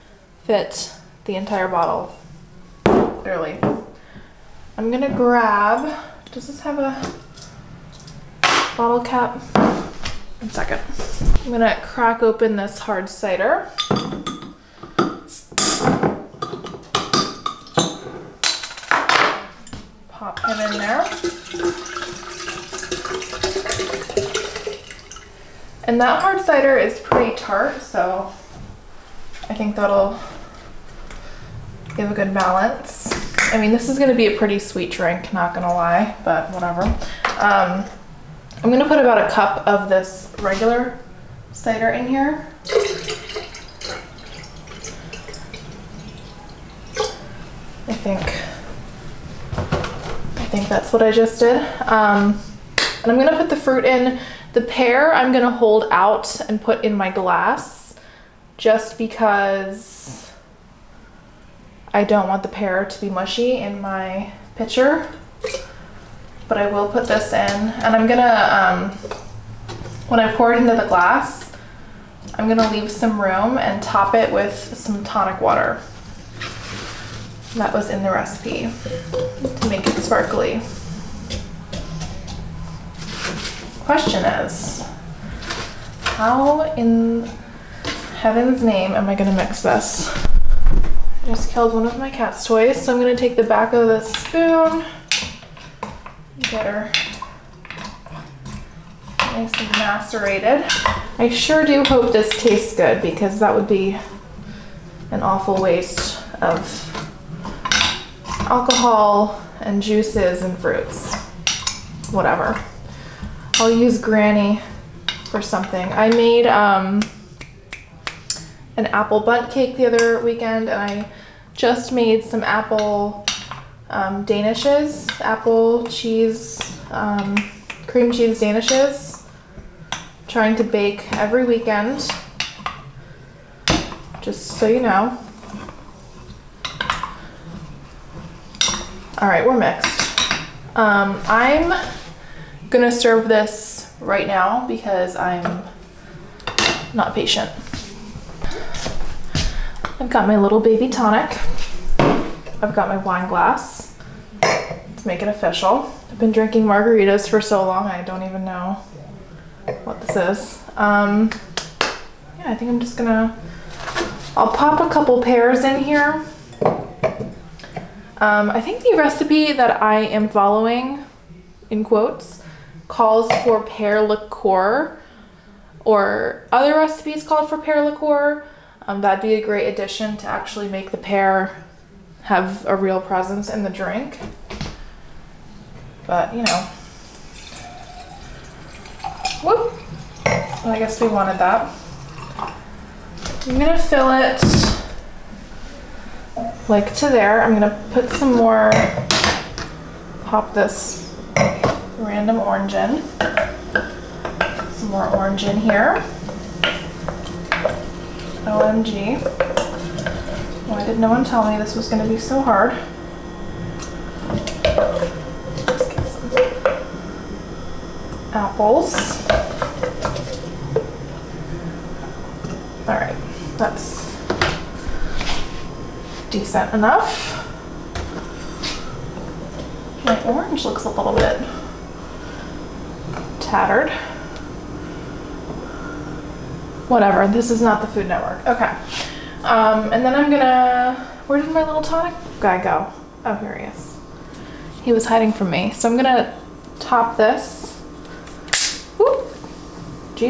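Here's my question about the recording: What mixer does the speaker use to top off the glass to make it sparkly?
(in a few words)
tonic water.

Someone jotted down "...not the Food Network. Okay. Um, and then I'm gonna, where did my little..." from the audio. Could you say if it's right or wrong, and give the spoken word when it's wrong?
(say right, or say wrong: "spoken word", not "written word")
right.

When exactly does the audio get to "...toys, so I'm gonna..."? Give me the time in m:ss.
1:32.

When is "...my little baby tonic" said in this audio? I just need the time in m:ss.
2:30.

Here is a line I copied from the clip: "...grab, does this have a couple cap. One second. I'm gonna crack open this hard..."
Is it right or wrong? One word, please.
wrong.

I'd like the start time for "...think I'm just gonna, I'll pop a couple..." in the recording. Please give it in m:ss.
2:42.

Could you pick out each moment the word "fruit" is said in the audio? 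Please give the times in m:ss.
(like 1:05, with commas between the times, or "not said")
0:53, 1:50.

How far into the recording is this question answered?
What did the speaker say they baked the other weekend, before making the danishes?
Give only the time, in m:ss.
1:58.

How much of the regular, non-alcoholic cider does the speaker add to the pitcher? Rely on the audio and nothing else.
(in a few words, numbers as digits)
1 cup.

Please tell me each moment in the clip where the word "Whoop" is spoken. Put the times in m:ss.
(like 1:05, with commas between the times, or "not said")
3:09, 4:08.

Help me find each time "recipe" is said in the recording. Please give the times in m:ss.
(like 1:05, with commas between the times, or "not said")
1:18, 2:48, 2:56.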